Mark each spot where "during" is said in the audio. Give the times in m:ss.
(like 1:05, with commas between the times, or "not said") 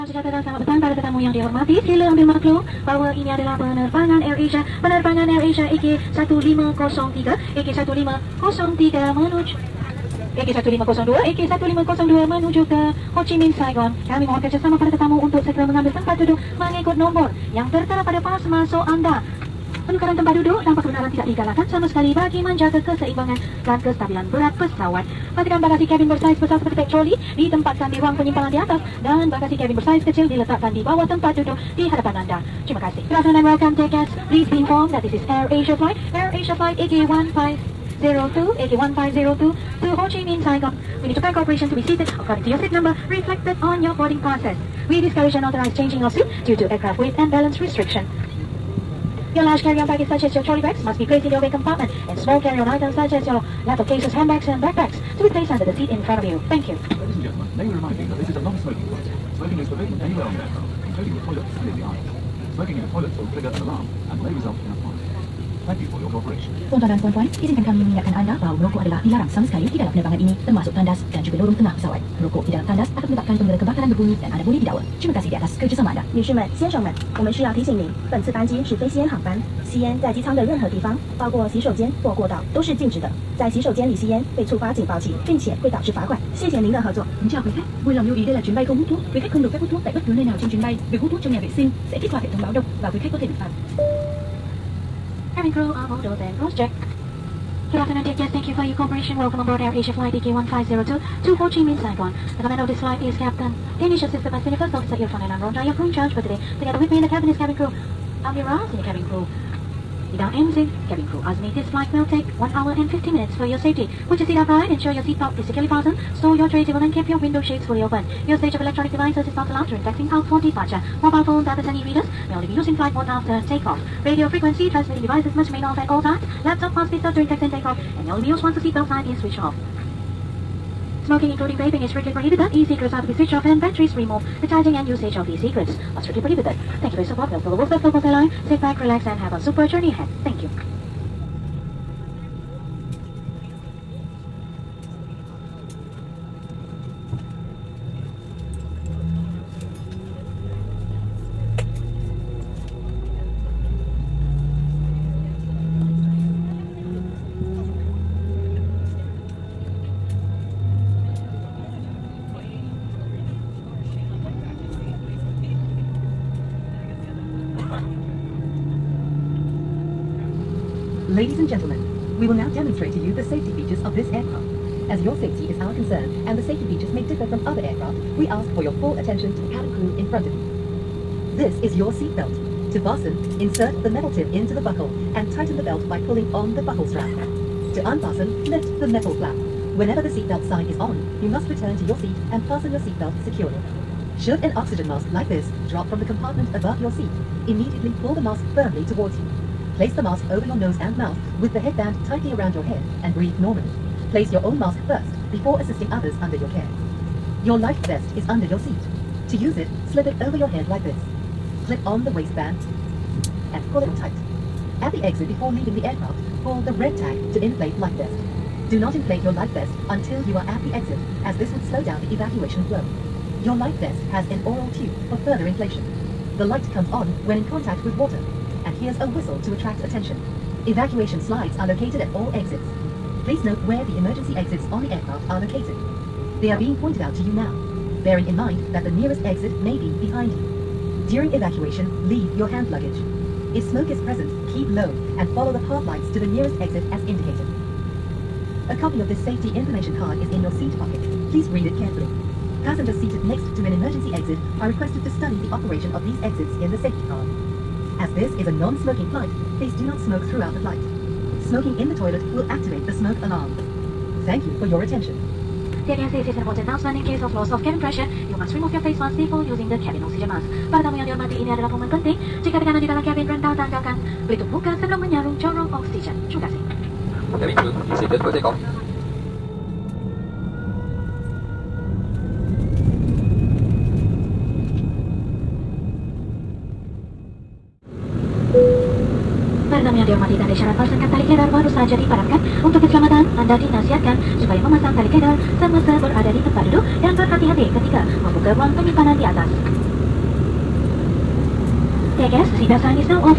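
1:59, 2:07, 4:01.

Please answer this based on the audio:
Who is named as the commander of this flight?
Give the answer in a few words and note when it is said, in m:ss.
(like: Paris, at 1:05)
Captain Danish, at 1:43.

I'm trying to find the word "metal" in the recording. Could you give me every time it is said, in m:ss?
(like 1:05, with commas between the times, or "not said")
3:03, 3:08.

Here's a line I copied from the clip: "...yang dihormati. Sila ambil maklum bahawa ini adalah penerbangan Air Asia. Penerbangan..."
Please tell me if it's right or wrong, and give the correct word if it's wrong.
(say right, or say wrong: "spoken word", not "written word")
right.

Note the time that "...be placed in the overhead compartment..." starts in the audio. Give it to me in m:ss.
0:50.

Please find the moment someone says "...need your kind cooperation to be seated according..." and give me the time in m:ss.
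0:41.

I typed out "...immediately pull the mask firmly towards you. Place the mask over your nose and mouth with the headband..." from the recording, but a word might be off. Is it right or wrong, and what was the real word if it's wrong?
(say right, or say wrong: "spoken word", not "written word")
right.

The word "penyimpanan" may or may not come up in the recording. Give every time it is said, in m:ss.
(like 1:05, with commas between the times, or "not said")
0:28, 4:58.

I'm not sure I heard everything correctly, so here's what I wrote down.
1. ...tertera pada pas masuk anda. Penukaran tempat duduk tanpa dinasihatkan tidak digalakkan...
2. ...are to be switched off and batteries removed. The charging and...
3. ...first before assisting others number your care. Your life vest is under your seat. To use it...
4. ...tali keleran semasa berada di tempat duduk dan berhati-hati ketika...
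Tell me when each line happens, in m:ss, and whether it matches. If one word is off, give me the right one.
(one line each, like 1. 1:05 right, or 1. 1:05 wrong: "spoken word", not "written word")
1. 0:17 wrong: "kebenaran", not "dinasihatkan"
2. 2:12 right
3. 3:24 wrong: "under", not "number"
4. 4:54 right.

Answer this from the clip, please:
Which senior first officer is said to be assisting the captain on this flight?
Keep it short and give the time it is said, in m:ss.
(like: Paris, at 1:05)
Irfan, at 1:44.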